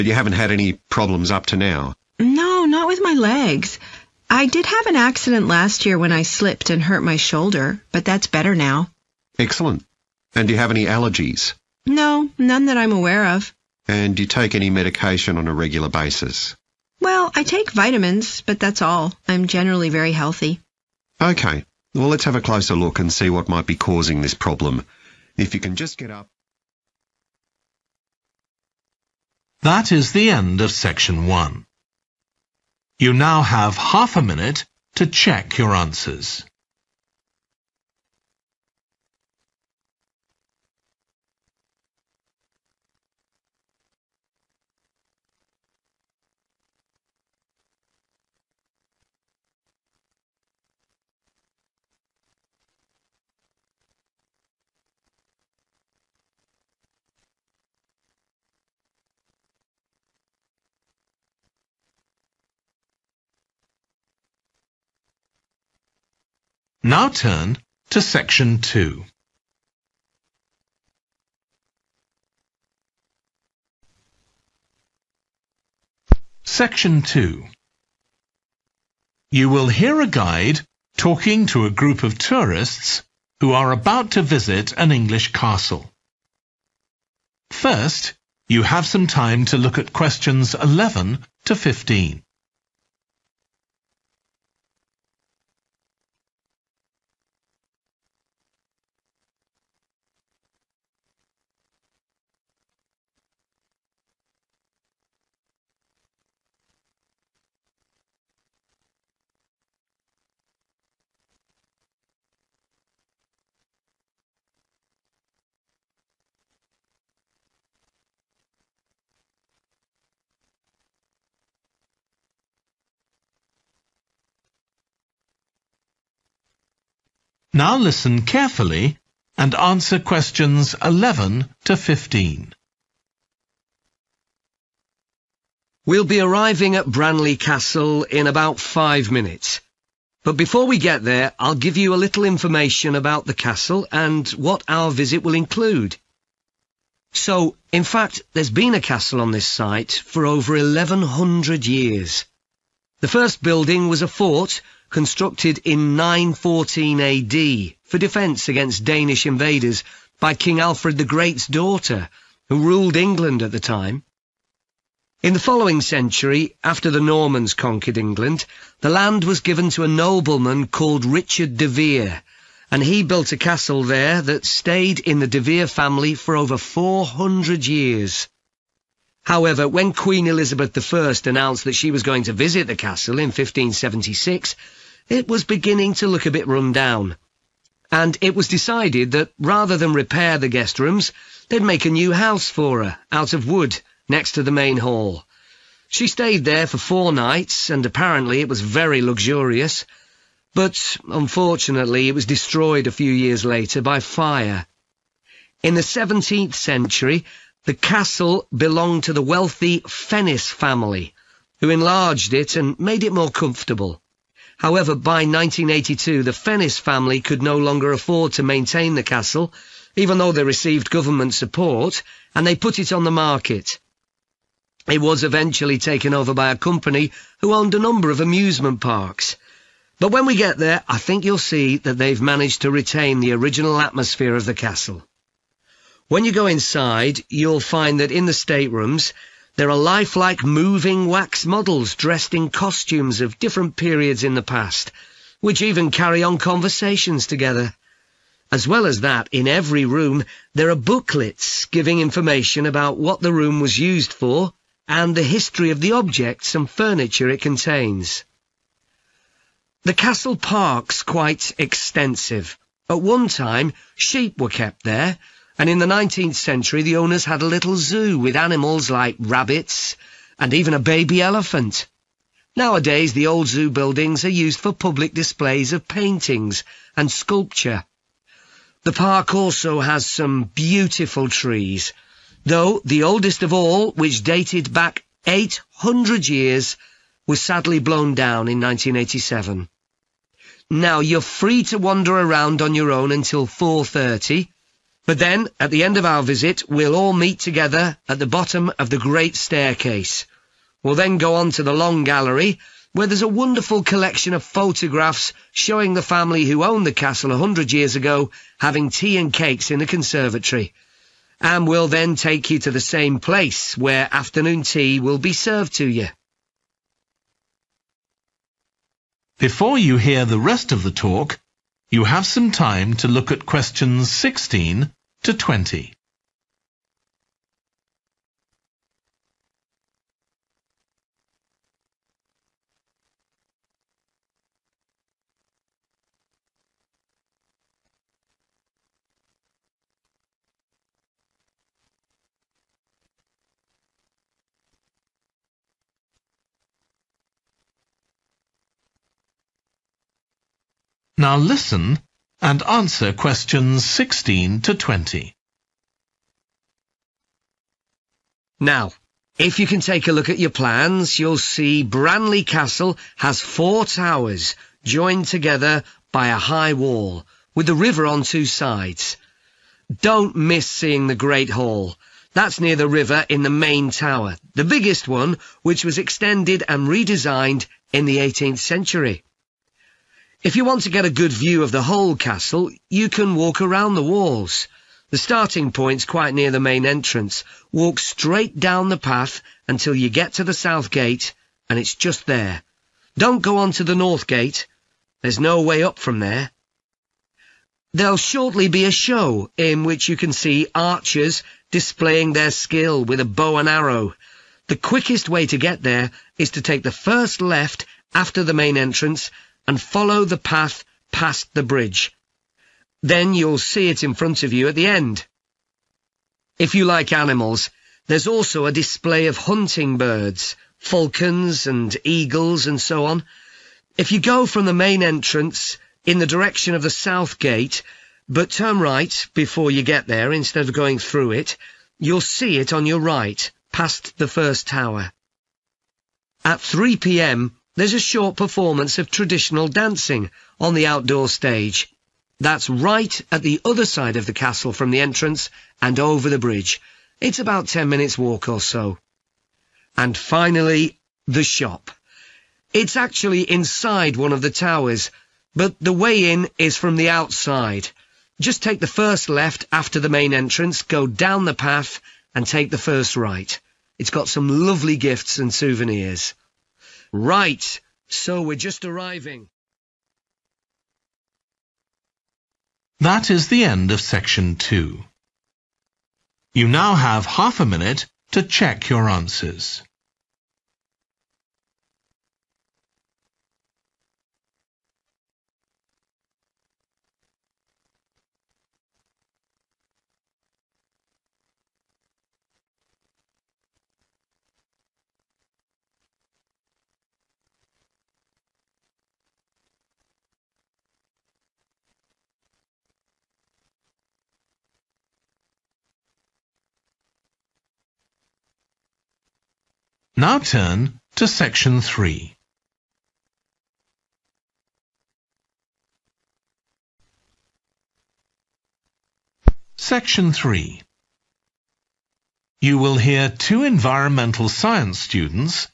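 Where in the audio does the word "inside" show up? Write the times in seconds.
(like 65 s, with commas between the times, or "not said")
236 s, 453 s.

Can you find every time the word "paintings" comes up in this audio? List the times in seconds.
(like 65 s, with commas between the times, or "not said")
275 s.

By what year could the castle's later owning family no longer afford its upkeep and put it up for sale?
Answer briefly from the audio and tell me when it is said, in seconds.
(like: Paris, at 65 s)
1982, at 215 s.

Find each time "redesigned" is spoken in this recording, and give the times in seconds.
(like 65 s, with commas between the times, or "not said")
376 s.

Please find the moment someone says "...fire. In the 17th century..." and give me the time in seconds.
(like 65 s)
203 s.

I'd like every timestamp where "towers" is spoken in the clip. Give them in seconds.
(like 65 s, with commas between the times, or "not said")
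363 s, 373 s, 434 s, 454 s.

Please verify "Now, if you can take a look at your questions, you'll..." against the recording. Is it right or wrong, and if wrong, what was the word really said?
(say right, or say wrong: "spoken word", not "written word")
wrong: "plans", not "questions".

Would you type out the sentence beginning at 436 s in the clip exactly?
At 3 p.m., there's a short performance of traditional dancing on the outdoor stage.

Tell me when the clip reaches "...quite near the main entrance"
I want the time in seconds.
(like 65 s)
386 s.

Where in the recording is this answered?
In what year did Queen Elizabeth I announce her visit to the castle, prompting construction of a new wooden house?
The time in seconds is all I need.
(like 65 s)
183 s.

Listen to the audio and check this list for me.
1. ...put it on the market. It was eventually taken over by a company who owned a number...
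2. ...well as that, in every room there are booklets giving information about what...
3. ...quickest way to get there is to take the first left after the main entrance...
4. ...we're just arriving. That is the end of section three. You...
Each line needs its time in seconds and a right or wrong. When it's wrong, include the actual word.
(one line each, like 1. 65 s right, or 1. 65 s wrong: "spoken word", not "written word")
1. 222 s right
2. 248 s right
3. 404 s right
4. 468 s wrong: "two", not "three".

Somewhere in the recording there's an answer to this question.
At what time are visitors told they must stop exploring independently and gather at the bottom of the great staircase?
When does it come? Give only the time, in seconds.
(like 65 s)
293 s.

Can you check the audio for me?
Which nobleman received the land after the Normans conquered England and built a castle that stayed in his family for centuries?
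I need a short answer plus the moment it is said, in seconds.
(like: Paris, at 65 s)
Richard de Vere, at 171 s.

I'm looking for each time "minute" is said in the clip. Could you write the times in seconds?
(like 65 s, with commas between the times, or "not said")
34 s, 139 s, 447 s, 477 s.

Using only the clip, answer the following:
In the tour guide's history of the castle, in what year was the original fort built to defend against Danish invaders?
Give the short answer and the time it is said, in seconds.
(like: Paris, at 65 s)
914 AD, at 155 s.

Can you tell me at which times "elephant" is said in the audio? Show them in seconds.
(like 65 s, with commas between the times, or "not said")
271 s.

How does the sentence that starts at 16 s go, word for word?
Well, I take vitamins, but that's all.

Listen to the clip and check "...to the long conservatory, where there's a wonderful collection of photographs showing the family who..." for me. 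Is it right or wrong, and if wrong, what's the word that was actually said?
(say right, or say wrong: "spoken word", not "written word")
wrong: "gallery", not "conservatory".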